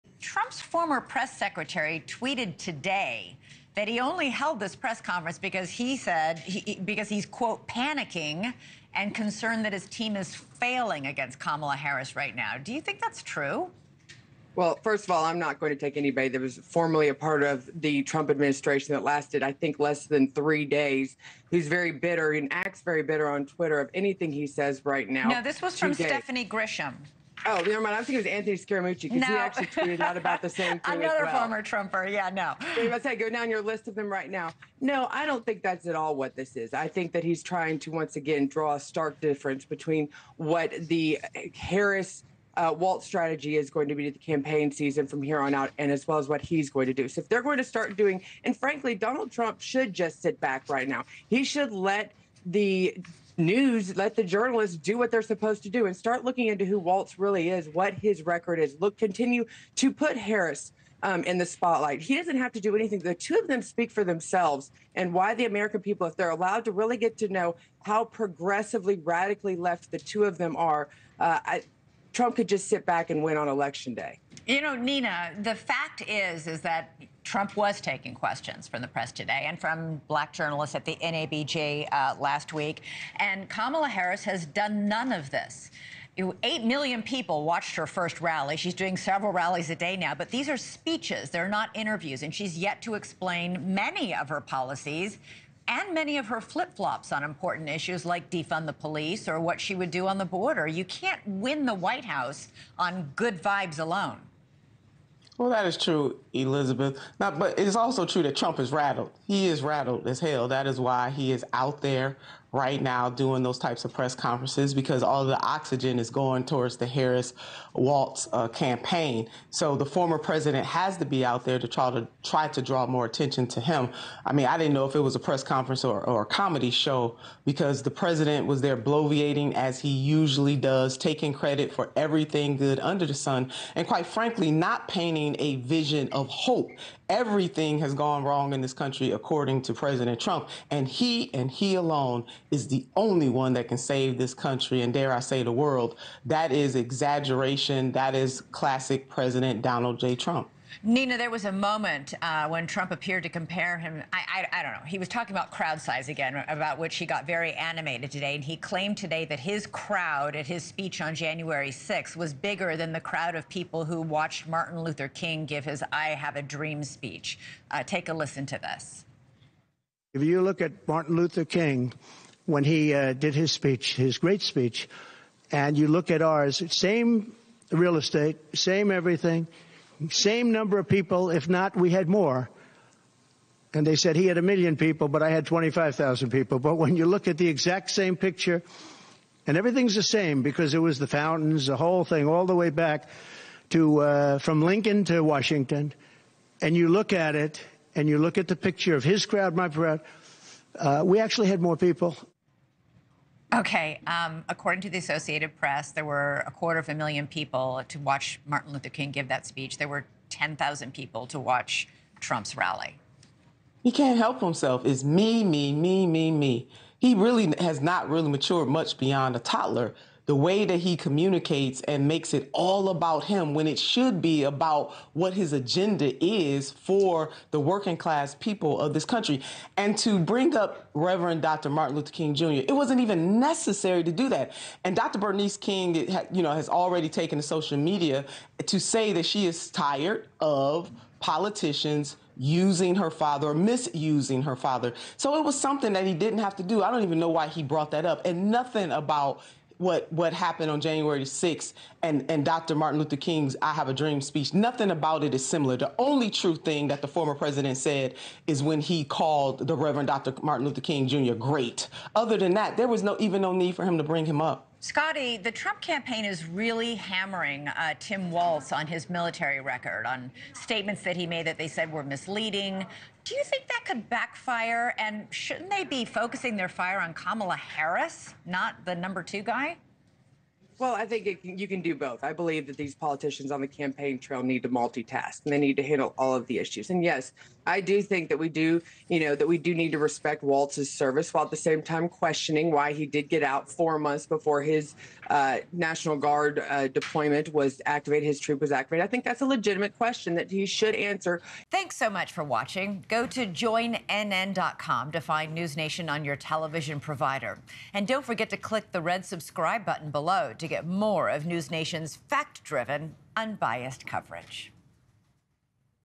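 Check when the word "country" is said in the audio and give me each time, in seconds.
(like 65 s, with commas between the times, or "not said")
138 s, 144 s, 229 s.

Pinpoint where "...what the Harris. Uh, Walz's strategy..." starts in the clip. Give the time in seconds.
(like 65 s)
40 s.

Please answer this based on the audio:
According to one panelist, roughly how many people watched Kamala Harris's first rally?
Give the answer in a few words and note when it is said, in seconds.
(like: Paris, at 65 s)
8 million, at 86 s.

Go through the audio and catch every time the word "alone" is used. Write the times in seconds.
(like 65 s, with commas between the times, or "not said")
103 s, 141 s.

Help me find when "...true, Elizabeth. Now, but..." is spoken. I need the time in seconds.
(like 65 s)
105 s.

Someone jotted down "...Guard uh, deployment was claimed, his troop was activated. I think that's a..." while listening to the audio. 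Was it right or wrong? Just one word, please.
wrong.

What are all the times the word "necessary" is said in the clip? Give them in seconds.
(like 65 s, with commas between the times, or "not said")
233 s.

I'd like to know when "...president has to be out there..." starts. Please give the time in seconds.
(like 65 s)
120 s.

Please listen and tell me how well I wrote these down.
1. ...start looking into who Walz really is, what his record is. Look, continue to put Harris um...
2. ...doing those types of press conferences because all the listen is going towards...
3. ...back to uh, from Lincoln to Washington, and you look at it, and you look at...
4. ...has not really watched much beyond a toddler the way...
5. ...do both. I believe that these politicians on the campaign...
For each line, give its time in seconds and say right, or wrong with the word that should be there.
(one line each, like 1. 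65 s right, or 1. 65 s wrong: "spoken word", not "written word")
1. 55 s right
2. 113 s wrong: "oxygen", not "listen"
3. 192 s right
4. 217 s wrong: "matured", not "watched"
5. 281 s right.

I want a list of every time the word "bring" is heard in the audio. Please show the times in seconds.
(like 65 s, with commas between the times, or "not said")
230 s, 264 s.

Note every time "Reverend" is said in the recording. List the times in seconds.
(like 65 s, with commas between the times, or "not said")
230 s, 259 s.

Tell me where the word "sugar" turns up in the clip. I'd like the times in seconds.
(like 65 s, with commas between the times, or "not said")
not said.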